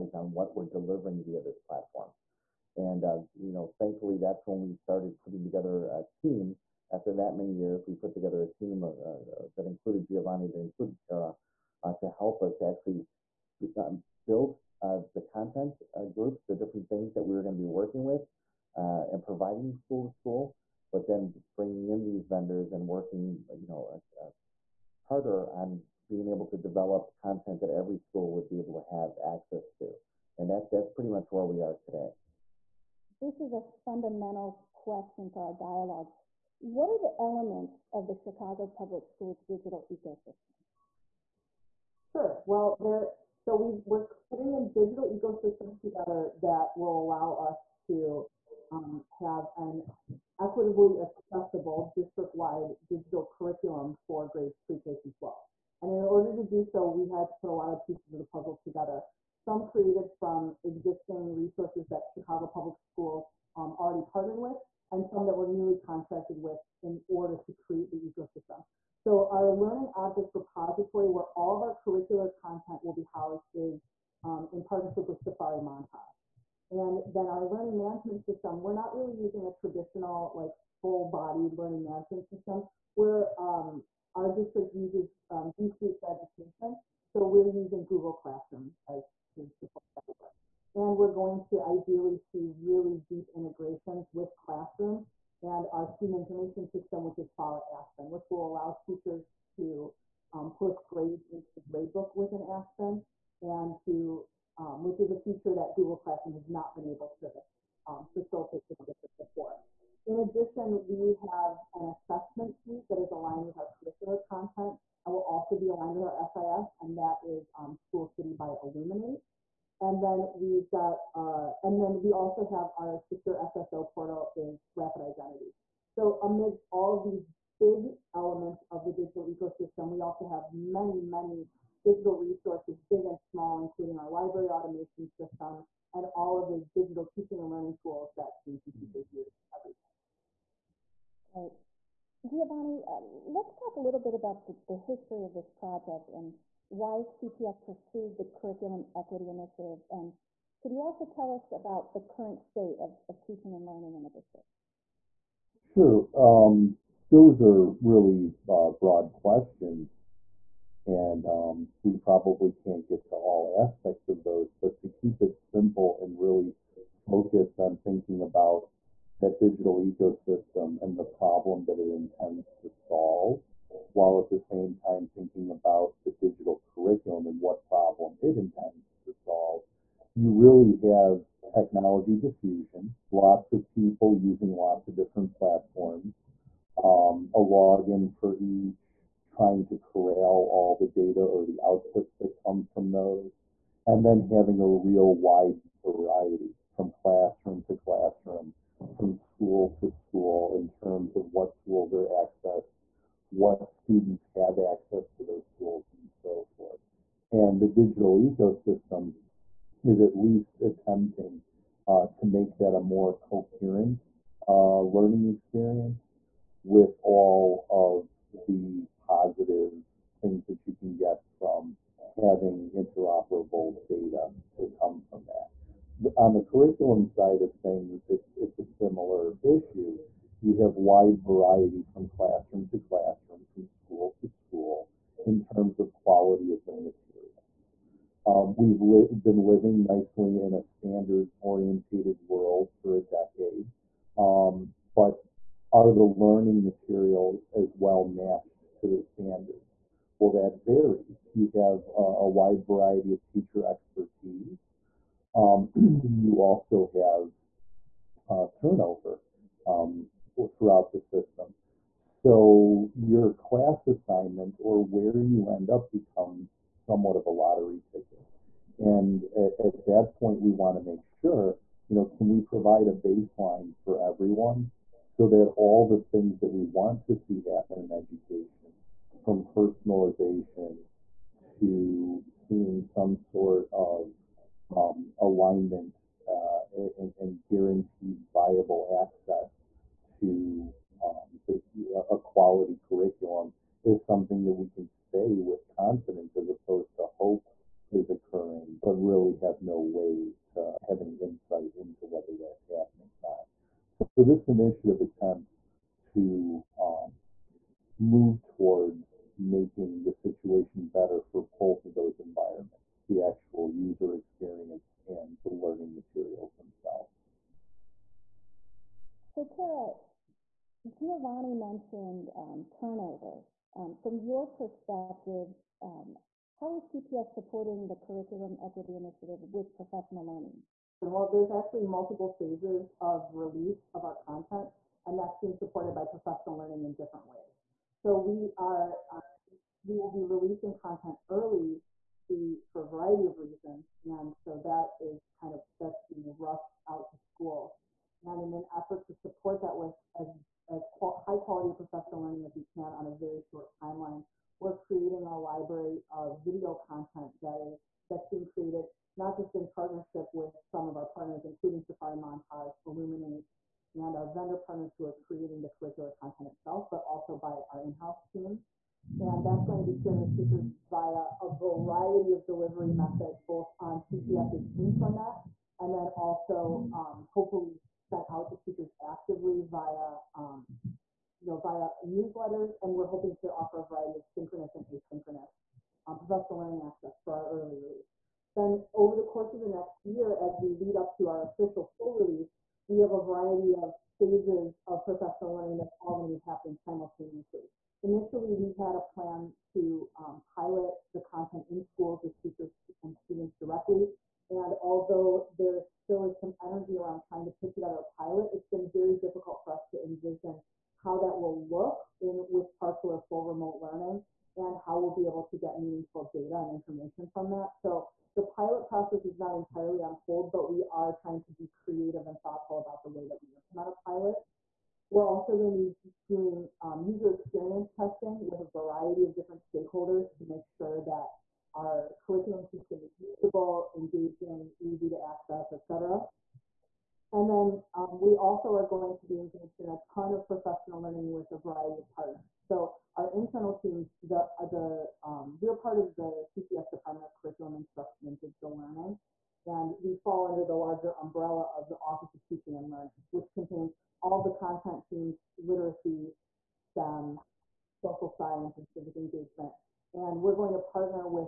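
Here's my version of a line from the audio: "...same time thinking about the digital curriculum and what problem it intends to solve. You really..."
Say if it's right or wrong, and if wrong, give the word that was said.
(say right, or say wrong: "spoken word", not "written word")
right.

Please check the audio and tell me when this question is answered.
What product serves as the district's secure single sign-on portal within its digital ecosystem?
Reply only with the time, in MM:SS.
02:04.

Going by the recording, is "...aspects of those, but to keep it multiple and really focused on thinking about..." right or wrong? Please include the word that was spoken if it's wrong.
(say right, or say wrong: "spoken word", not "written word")
wrong: "simple", not "multiple".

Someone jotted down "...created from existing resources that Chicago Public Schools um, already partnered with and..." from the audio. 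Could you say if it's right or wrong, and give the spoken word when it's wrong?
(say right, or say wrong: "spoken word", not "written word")
right.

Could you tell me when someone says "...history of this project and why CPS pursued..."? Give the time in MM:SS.
02:24.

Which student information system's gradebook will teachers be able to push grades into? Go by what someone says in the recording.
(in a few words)
Follett Aspen.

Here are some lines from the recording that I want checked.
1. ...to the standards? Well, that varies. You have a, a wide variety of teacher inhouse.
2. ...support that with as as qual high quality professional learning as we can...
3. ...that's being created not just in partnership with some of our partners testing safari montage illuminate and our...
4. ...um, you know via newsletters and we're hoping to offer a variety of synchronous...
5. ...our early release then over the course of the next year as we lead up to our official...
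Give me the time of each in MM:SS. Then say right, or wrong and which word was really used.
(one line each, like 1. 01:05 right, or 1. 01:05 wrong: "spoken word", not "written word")
1. 04:08 wrong: "expertise", not "inhouse"
2. 05:49 right
3. 05:58 wrong: "including", not "testing"
4. 06:20 right
5. 06:27 right.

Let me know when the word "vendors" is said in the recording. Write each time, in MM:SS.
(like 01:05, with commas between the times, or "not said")
00:22, 06:04.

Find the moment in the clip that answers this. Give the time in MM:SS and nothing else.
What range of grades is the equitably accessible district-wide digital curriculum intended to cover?
00:54.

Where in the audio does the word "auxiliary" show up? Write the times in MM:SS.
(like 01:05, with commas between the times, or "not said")
not said.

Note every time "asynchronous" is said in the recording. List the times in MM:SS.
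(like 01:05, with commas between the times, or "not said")
06:24.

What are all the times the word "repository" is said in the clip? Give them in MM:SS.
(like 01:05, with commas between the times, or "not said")
01:10.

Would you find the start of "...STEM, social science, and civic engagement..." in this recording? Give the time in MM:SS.
07:36.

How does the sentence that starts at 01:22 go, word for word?
We're, um, our district uses um, G Suite for education.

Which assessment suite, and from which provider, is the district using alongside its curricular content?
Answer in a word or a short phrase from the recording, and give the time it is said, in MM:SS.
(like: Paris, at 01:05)
School City by Illuminate, at 01:57.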